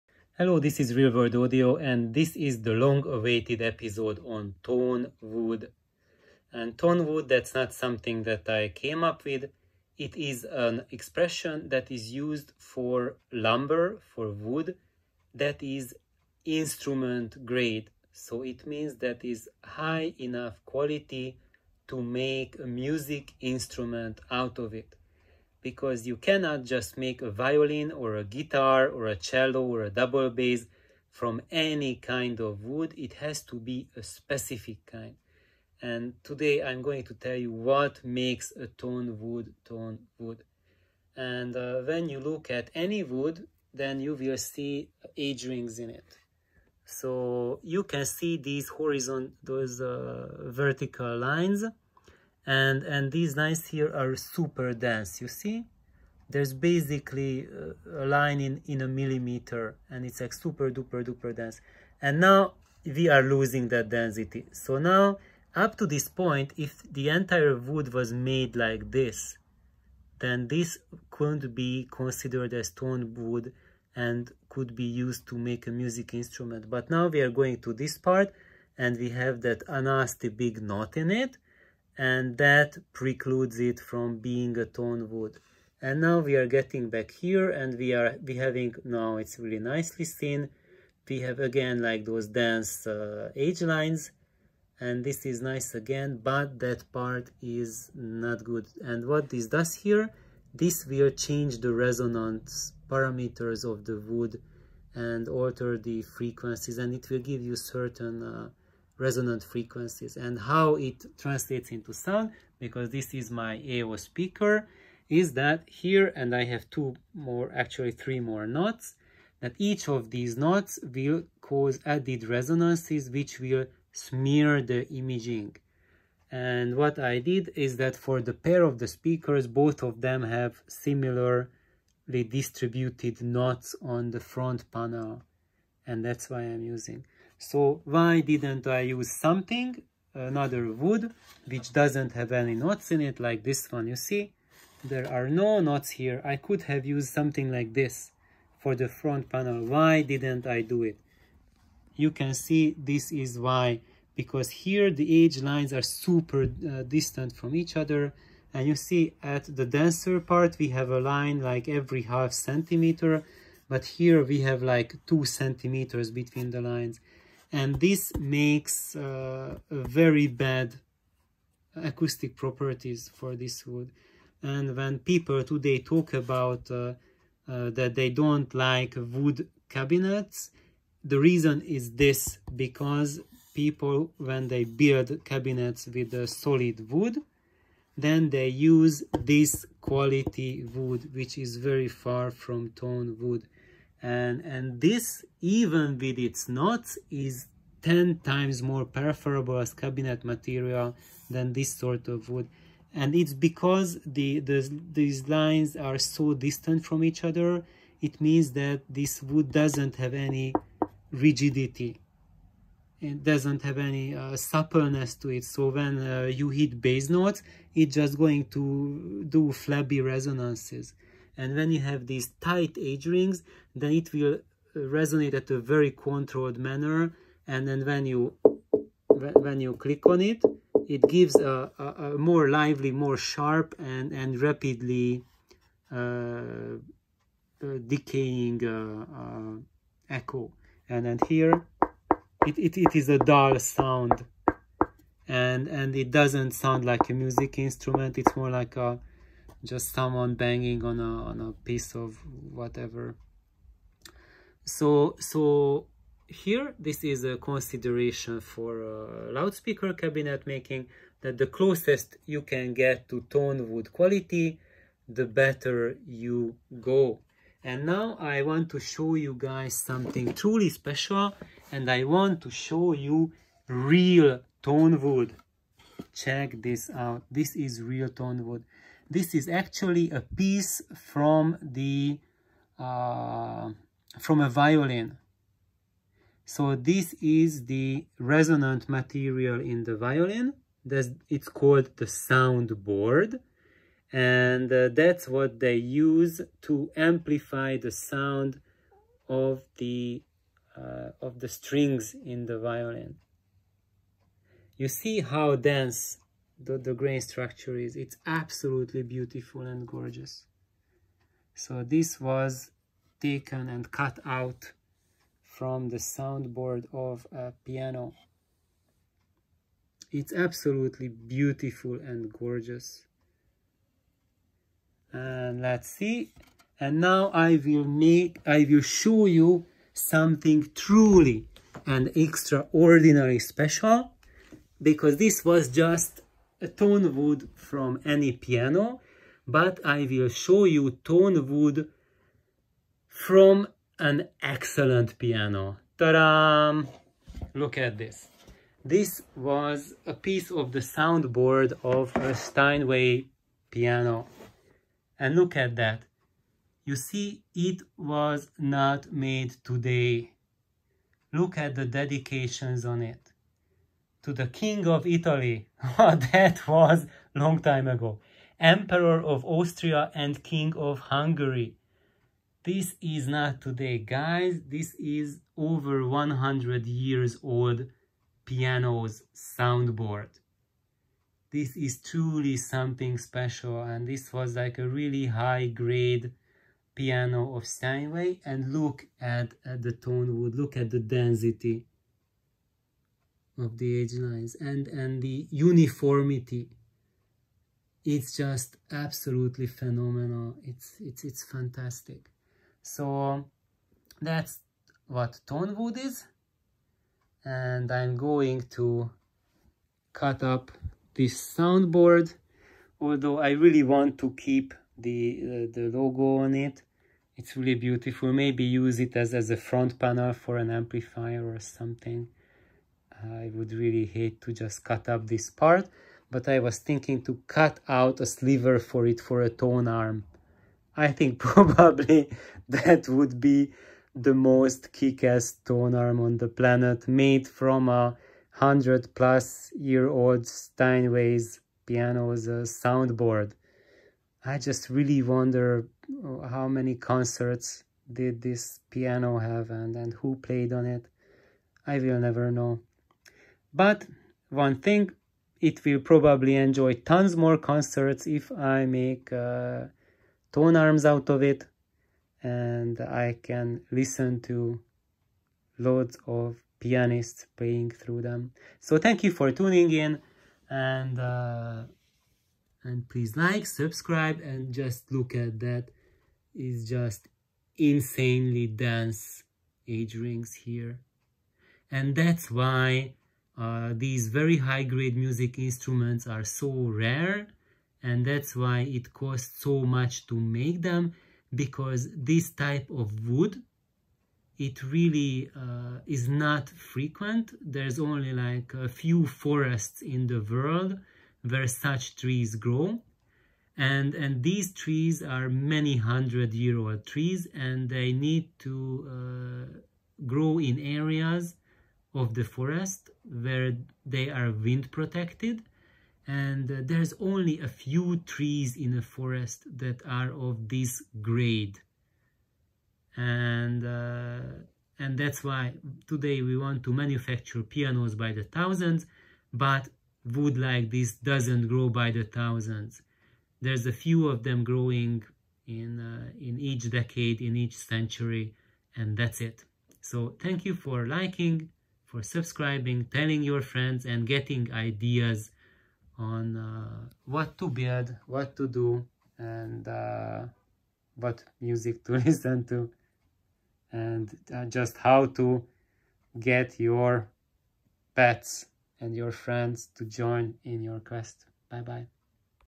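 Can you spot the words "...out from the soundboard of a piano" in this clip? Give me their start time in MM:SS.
05:14.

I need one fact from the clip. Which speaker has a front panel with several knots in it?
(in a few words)
AO speaker.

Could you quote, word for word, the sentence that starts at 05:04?
You see how dense the, the grain structure is.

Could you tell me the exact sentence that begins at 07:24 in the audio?
I just really wonder uh, how many concerts did this piano have and, and who played on it.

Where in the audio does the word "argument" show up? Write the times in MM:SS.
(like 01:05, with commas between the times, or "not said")
not said.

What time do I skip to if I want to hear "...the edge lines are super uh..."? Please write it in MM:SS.
02:34.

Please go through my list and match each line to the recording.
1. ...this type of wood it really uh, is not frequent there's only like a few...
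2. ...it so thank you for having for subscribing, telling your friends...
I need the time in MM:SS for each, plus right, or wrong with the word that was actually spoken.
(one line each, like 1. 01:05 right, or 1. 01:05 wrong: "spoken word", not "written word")
1. 08:12 right
2. 08:59 wrong: "liking", not "having".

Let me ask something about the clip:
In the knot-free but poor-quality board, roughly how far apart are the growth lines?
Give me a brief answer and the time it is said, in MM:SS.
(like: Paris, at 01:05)
2 centimeters, at 02:45.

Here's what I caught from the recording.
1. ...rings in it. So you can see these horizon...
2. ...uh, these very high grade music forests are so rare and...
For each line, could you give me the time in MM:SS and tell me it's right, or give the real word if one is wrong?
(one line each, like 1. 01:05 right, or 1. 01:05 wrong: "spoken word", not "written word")
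1. 00:45 right
2. 08:03 wrong: "instruments", not "forests".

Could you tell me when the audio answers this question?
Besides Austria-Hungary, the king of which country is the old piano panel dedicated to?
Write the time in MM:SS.
06:04.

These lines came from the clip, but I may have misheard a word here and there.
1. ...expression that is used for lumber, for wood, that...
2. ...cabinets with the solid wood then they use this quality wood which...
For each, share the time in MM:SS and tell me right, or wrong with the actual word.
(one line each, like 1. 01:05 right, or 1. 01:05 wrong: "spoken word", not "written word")
1. 00:10 right
2. 03:05 right.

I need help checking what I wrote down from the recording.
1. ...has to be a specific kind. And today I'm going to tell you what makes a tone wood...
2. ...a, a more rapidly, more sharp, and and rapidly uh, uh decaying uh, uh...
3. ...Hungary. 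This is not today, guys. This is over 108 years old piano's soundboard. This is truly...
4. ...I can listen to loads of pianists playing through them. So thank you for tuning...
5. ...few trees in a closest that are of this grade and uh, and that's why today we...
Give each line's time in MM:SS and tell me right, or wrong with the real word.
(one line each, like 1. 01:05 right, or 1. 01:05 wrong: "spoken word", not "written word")
1. 00:33 right
2. 03:51 wrong: "lively", not "rapidly"
3. 06:11 wrong: "100", not "108"
4. 07:42 right
5. 08:37 wrong: "forest", not "closest".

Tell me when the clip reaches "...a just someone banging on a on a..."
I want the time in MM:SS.
04:08.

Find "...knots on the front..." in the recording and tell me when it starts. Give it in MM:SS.
02:13.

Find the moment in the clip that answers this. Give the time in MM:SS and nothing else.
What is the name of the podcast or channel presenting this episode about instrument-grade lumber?
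00:00.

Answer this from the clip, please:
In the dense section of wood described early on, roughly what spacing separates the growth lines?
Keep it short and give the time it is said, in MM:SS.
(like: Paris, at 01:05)
1 millimeter, at 00:58.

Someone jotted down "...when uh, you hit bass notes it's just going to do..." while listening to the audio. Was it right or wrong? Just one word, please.
right.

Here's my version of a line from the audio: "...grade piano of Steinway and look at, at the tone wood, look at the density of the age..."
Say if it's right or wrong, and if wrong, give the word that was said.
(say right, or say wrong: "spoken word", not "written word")
right.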